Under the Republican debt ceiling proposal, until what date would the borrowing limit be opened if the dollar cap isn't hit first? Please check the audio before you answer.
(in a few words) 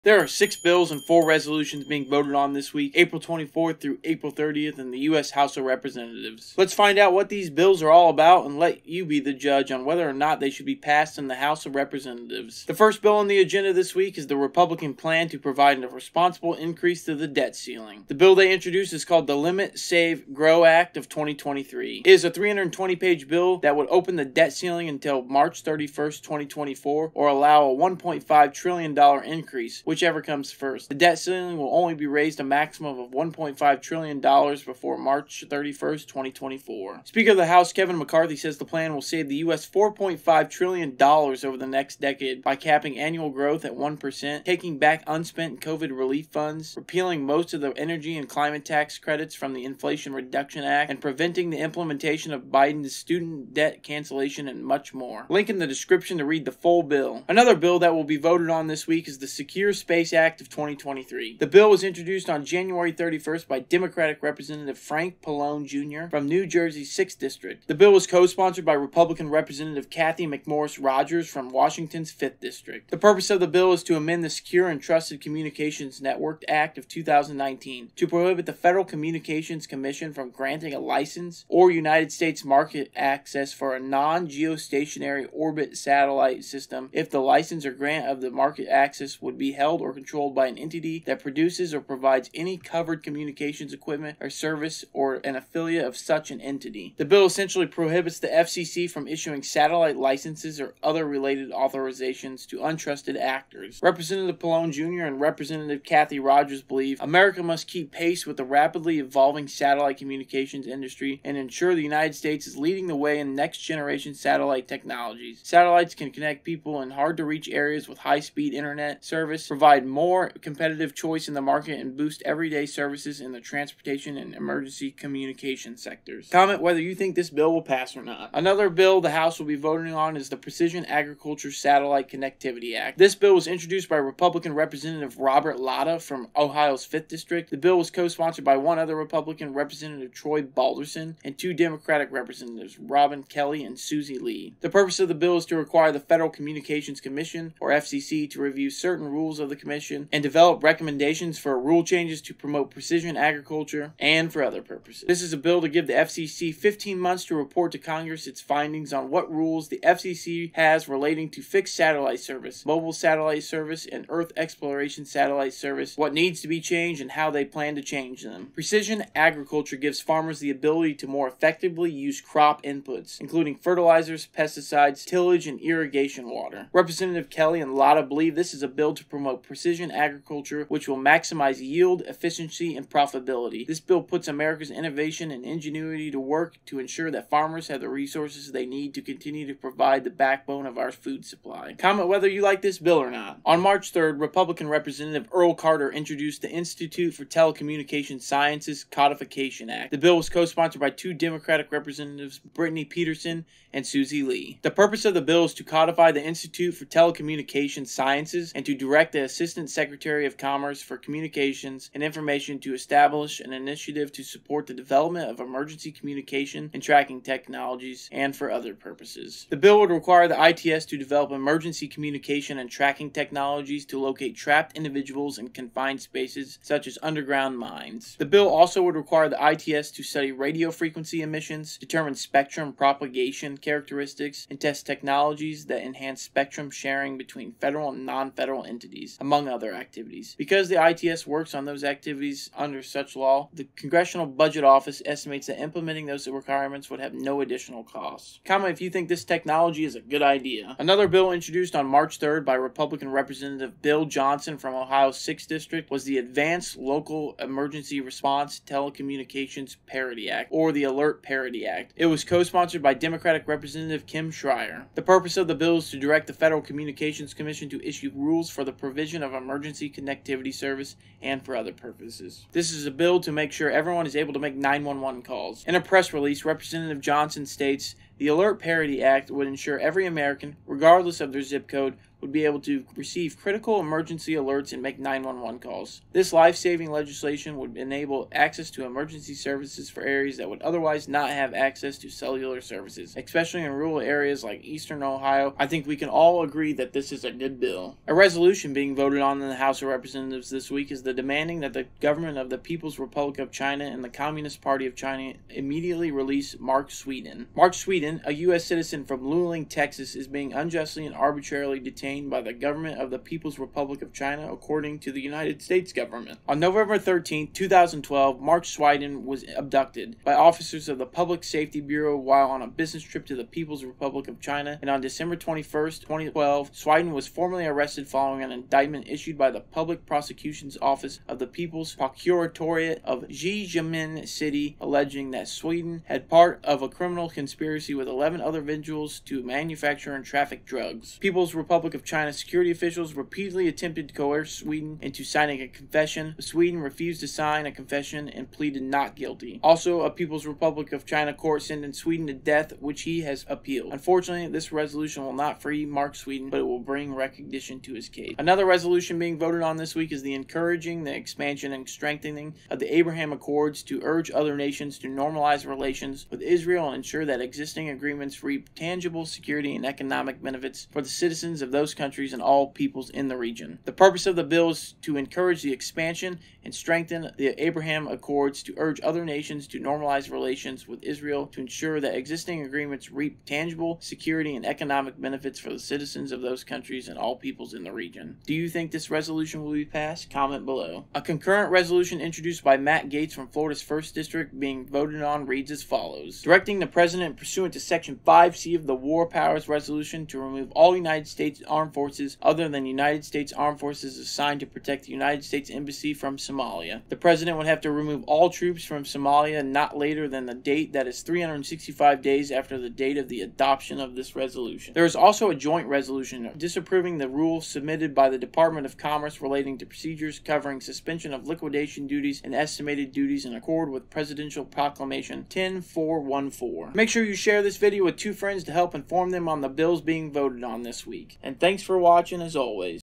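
March 31st, 2024.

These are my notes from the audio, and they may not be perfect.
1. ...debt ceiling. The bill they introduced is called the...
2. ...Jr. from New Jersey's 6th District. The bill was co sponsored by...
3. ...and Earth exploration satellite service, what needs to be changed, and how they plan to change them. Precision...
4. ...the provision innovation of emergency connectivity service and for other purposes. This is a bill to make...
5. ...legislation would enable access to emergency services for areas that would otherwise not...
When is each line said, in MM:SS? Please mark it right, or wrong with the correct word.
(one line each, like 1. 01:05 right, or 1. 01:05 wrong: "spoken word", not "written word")
1. 00:17 right
2. 01:05 right
3. 02:43 right
4. 04:28 wrong: "provision", not "innovation"
5. 04:46 right.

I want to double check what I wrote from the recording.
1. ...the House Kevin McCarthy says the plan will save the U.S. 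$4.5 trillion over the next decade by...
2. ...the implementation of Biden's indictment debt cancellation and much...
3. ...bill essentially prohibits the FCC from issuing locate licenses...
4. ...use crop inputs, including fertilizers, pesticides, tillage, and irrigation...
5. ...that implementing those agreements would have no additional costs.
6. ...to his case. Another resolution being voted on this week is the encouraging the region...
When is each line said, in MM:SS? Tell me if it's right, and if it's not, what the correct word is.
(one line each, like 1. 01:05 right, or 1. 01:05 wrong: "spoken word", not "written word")
1. 00:37 right
2. 00:51 wrong: "student", not "indictment"
3. 01:37 wrong: "satellite", not "locate"
4. 02:51 right
5. 04:05 wrong: "requirements", not "agreements"
6. 05:57 wrong: "expansion", not "region".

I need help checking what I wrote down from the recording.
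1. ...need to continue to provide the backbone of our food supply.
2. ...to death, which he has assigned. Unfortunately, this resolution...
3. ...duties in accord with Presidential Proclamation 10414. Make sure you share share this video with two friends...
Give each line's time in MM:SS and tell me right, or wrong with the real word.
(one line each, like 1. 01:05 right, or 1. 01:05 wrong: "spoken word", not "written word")
1. 03:08 right
2. 05:52 wrong: "appealed", not "assigned"
3. 07:03 right.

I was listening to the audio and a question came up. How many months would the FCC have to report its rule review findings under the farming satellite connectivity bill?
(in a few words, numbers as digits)
15.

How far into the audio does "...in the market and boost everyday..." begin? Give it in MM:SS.
02:01.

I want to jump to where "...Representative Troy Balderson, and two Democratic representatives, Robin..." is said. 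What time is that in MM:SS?
02:19.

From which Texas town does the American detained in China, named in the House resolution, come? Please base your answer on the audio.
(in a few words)
Luling.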